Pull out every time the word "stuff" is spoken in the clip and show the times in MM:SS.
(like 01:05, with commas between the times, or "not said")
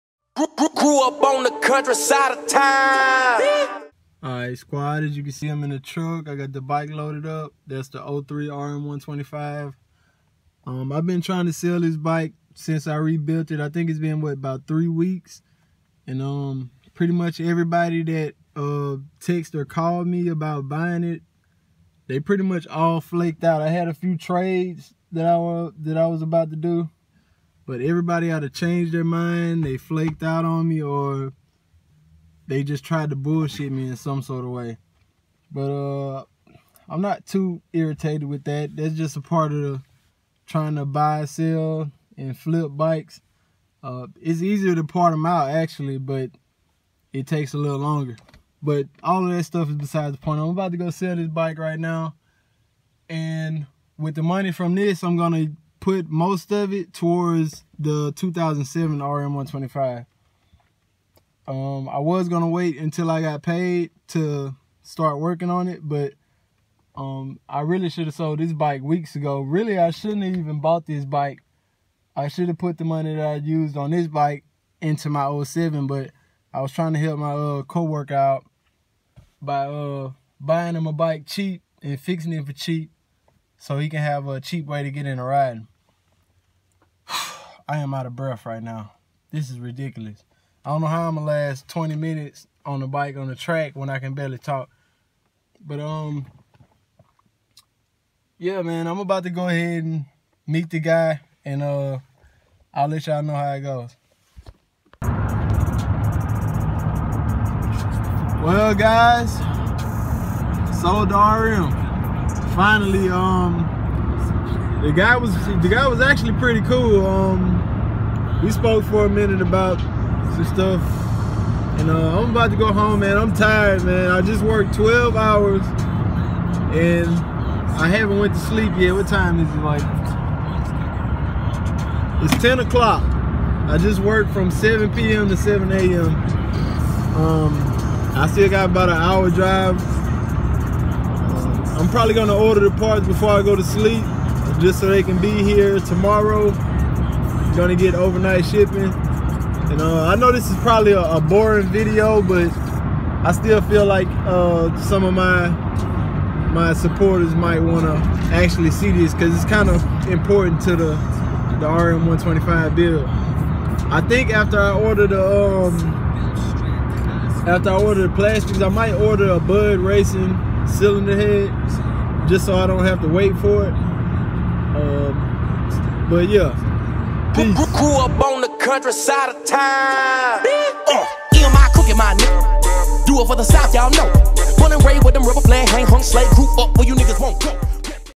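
00:49, 02:00.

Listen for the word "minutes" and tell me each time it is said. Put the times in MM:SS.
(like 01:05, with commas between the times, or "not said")
01:31, 01:59.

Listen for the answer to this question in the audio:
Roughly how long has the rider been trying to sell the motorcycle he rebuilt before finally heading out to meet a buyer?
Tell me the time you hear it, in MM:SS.
00:14.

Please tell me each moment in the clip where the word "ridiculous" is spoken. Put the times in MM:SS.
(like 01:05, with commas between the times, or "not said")
01:29.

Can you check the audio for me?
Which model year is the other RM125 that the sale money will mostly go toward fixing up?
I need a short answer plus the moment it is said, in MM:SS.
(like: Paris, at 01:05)
2007, at 00:58.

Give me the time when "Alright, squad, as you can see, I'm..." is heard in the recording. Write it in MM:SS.
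00:04.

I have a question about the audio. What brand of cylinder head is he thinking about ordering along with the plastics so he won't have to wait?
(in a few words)
Bud Racing.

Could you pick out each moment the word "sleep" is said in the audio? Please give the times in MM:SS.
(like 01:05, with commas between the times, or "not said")
02:08, 02:23.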